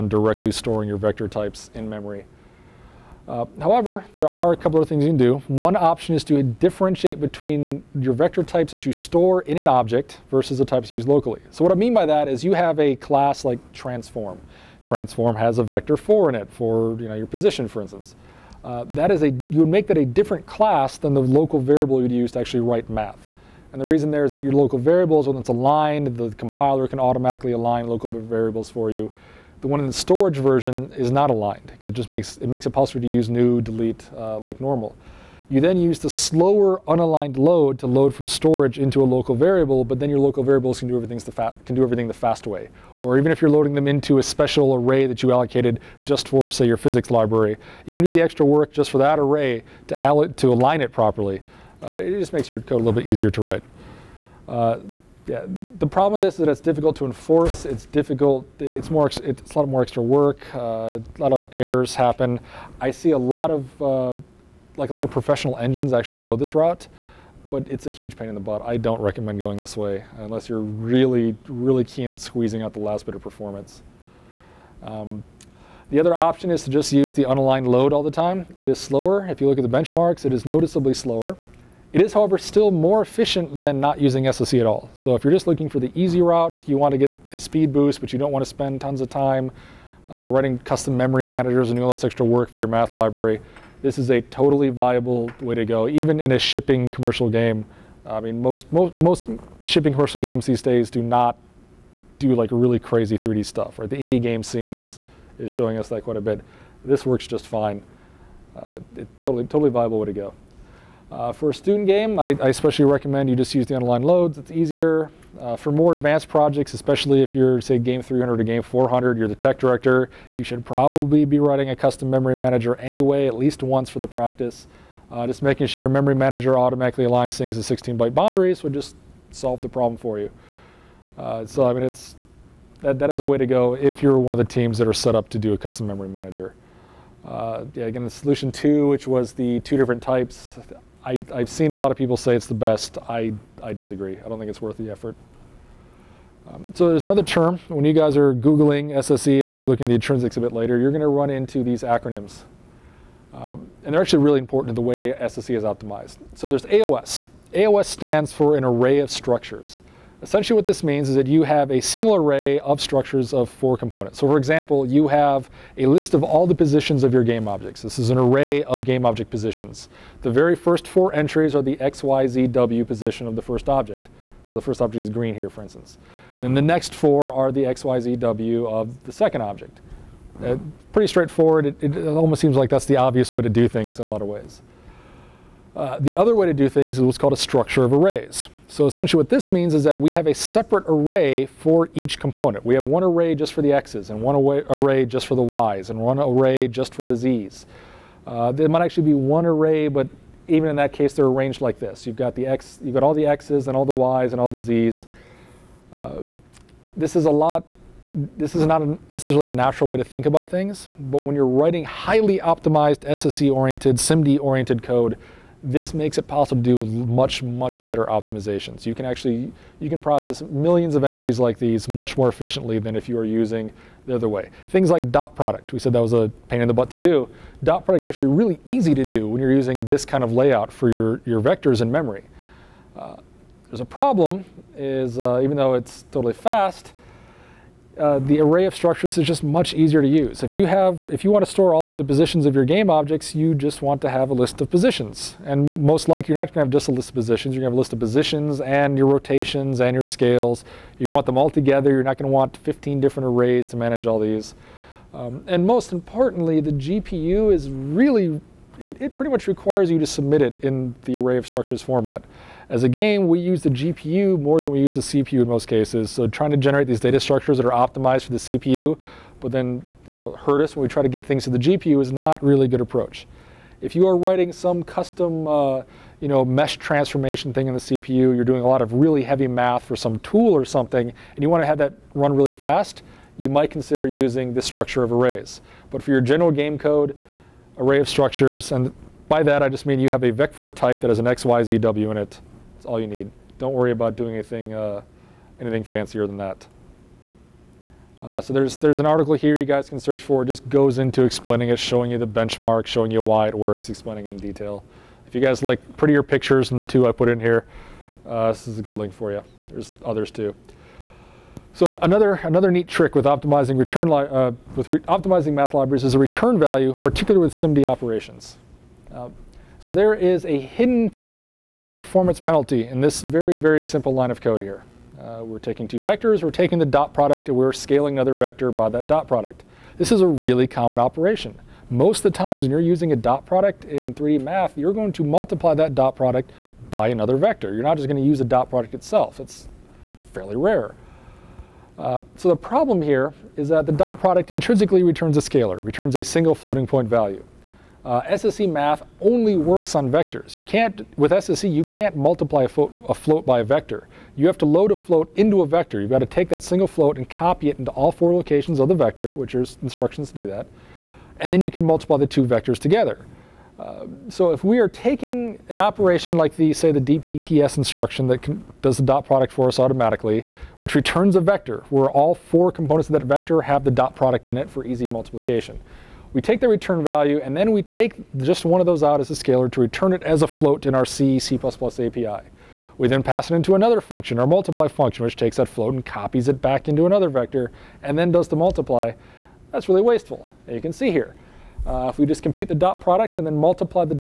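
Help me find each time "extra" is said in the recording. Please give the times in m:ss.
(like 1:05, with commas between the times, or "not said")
0:48, 0:59, 1:32.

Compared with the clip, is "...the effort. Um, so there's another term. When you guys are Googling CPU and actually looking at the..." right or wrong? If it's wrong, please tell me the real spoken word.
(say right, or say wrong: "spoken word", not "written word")
wrong: "SSE", not "CPU".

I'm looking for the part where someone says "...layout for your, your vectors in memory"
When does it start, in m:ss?
3:50.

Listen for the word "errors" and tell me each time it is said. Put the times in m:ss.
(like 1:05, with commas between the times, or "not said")
1:01.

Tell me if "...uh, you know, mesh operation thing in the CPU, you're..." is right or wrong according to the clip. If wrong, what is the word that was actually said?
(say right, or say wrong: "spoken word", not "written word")
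wrong: "transformation", not "operation".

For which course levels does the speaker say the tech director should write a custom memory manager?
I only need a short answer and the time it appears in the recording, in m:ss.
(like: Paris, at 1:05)
Game 300 or Game 400, at 1:57.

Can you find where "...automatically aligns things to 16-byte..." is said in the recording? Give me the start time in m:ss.
2:06.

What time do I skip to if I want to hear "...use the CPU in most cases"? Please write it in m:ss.
4:24.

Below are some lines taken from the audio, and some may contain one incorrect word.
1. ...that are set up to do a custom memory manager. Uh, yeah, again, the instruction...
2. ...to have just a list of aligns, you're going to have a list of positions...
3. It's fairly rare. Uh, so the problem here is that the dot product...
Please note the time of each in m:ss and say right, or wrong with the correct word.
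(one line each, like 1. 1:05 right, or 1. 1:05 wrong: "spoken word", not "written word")
1. 2:14 wrong: "solution", not "instruction"
2. 4:06 wrong: "positions", not "aligns"
3. 5:39 right.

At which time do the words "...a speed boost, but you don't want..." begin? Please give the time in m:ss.
1:27.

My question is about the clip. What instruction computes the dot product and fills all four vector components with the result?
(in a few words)
DPPS.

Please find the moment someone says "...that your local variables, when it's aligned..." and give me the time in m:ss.
0:24.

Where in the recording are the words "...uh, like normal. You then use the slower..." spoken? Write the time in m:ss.
0:34.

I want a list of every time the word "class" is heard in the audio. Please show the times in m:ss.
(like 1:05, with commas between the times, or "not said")
0:12, 0:20.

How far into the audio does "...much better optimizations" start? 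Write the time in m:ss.
3:37.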